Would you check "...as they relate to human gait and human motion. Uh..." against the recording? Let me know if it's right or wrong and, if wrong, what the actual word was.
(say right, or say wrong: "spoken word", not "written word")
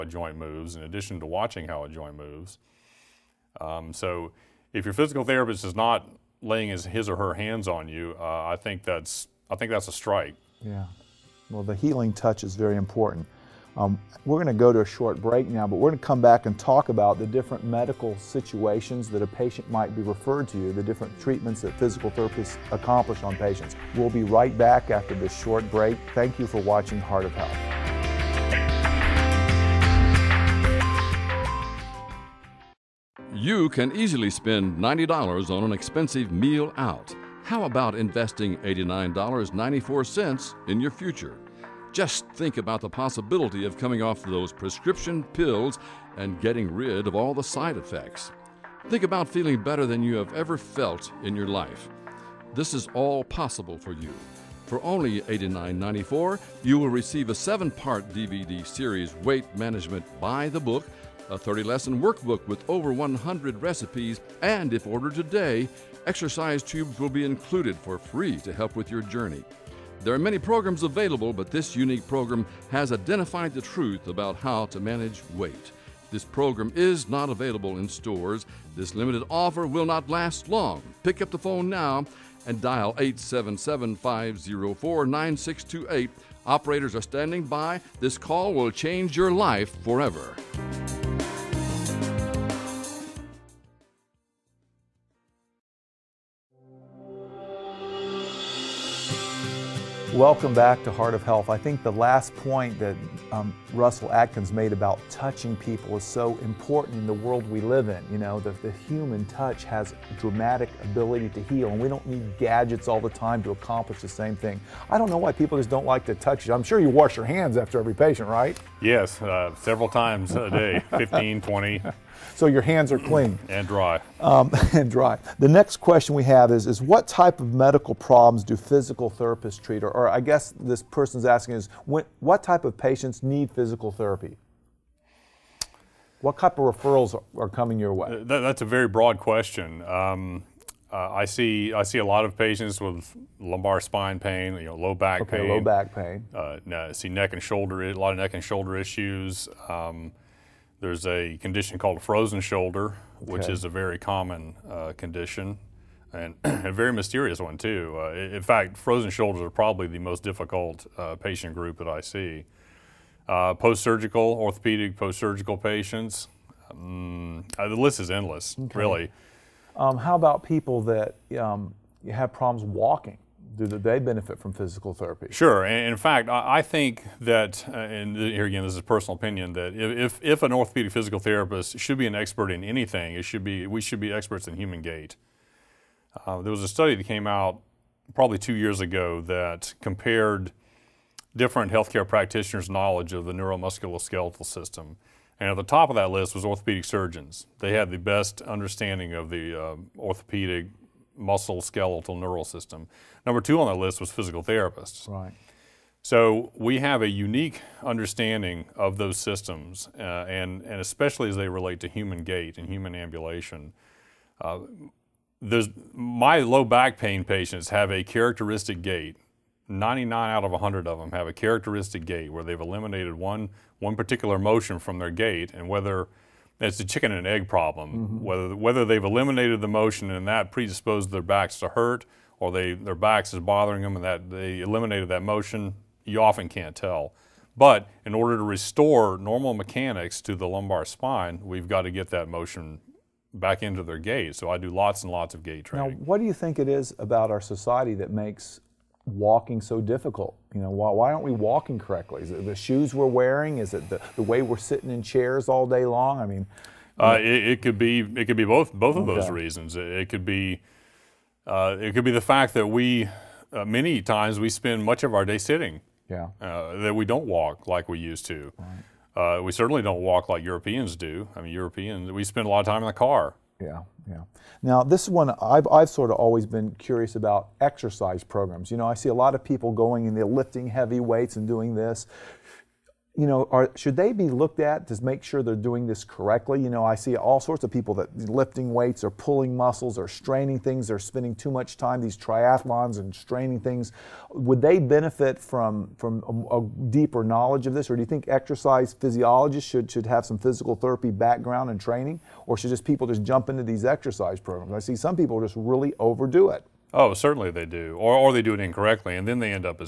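wrong: "ambulation", not "motion".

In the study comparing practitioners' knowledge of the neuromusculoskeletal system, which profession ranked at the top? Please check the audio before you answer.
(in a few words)
orthopedic surgeons.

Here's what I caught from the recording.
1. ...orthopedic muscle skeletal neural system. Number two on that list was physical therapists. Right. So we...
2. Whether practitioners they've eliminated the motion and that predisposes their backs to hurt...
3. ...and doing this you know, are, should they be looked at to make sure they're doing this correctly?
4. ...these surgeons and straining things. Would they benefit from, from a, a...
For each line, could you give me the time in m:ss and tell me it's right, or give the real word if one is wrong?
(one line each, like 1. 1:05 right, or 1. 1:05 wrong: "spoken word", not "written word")
1. 3:19 right
2. 3:48 wrong: "whether", not "practitioners"
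3. 4:41 right
4. 4:51 wrong: "triathlons", not "surgeons".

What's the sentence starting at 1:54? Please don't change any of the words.
I don't know why people just don't like to touch you.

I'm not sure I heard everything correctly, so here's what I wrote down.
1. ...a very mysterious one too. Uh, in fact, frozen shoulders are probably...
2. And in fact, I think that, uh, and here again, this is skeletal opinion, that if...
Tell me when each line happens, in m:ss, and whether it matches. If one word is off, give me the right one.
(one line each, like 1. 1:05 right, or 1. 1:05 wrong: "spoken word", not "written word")
1. 2:36 right
2. 2:55 wrong: "personal", not "skeletal".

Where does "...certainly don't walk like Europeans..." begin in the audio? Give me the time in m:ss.
4:29.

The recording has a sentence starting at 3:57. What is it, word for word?
But in order to restore normal mechanics to the lumbar spine, we've got to get that motion back into their gait.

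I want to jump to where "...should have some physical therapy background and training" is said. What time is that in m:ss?
4:59.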